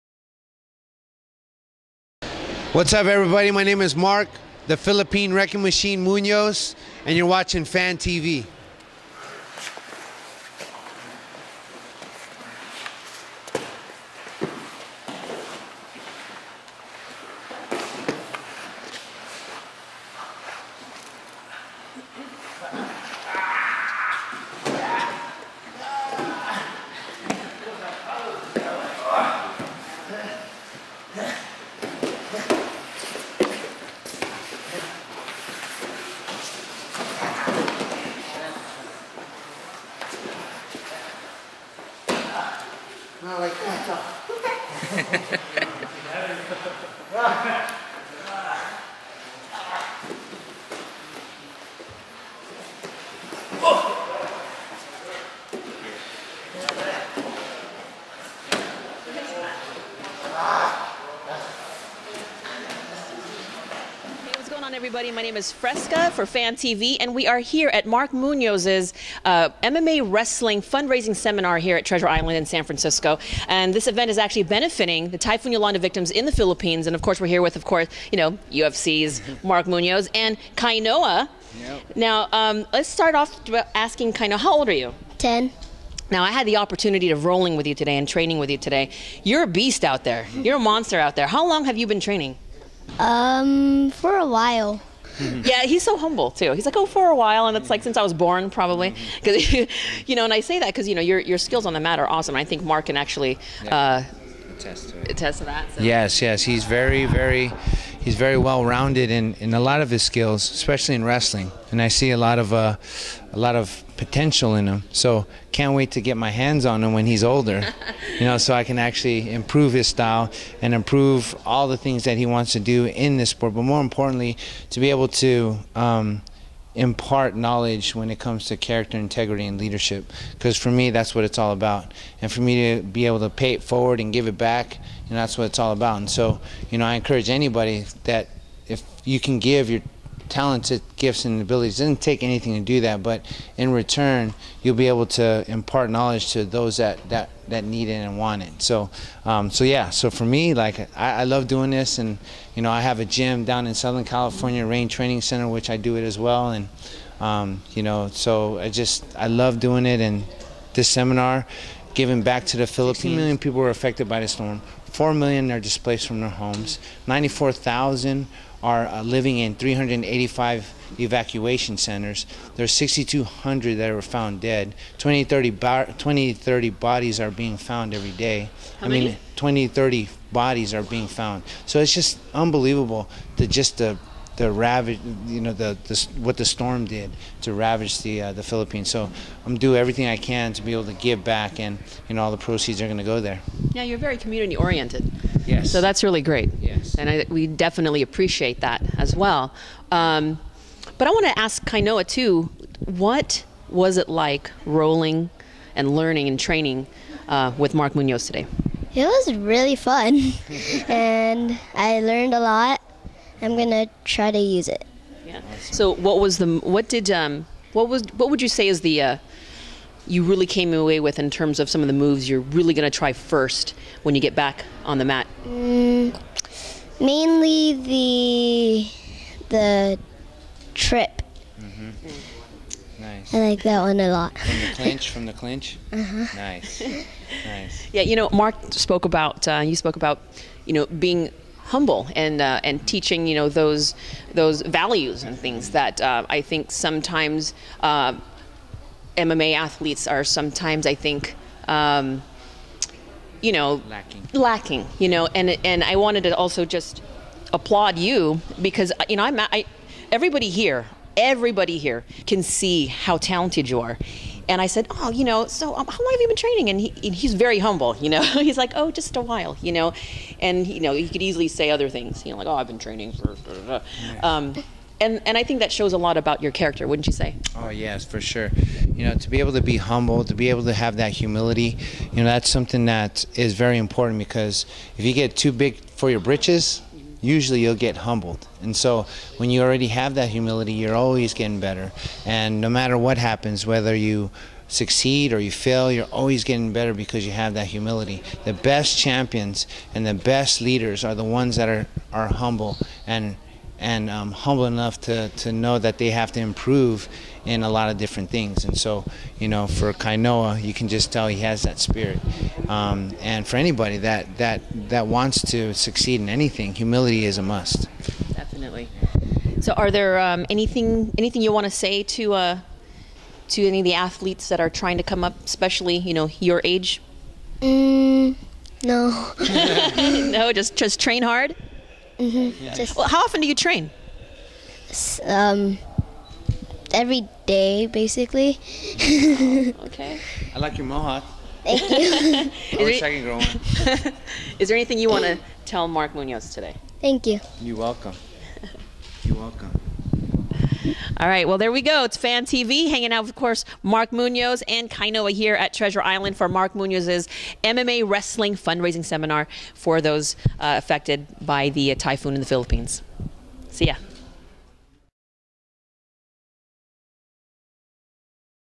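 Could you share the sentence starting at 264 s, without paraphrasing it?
And I said, oh, you know, so um, how long have you been training?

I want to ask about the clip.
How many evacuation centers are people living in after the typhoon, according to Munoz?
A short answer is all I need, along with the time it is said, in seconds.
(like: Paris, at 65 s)
385, at 169 s.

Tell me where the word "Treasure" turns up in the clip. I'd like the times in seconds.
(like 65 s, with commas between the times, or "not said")
71 s, 355 s.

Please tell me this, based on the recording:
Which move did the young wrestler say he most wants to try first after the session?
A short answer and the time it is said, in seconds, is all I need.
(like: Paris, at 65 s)
The trip, at 229 s.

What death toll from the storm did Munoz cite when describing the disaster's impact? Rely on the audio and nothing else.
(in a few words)
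6,200.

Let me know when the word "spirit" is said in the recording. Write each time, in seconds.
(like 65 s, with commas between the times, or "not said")
311 s.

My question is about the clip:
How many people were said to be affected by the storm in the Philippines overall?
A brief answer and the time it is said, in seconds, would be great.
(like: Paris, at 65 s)
16 million, at 162 s.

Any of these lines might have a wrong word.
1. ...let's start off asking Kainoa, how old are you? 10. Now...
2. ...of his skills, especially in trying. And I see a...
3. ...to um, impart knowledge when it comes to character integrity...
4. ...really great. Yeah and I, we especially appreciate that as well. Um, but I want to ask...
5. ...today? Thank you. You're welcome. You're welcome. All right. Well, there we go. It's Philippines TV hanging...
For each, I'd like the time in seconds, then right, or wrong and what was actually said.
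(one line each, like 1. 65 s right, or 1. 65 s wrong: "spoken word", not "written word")
1. 82 s right
2. 109 s wrong: "wrestling", not "trying"
3. 125 s right
4. 196 s wrong: "definitely", not "especially"
5. 346 s wrong: "Fan", not "Philippines".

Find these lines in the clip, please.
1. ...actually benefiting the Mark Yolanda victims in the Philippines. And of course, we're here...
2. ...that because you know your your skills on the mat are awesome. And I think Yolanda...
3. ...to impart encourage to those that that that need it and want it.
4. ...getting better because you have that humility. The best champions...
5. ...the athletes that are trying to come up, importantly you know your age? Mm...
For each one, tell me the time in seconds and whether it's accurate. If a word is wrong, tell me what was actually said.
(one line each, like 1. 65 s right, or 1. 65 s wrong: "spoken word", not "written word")
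1. 74 s wrong: "Typhoon", not "Mark"
2. 100 s wrong: "Mark", not "Yolanda"
3. 145 s wrong: "knowledge", not "encourage"
4. 296 s right
5. 323 s wrong: "especially", not "importantly".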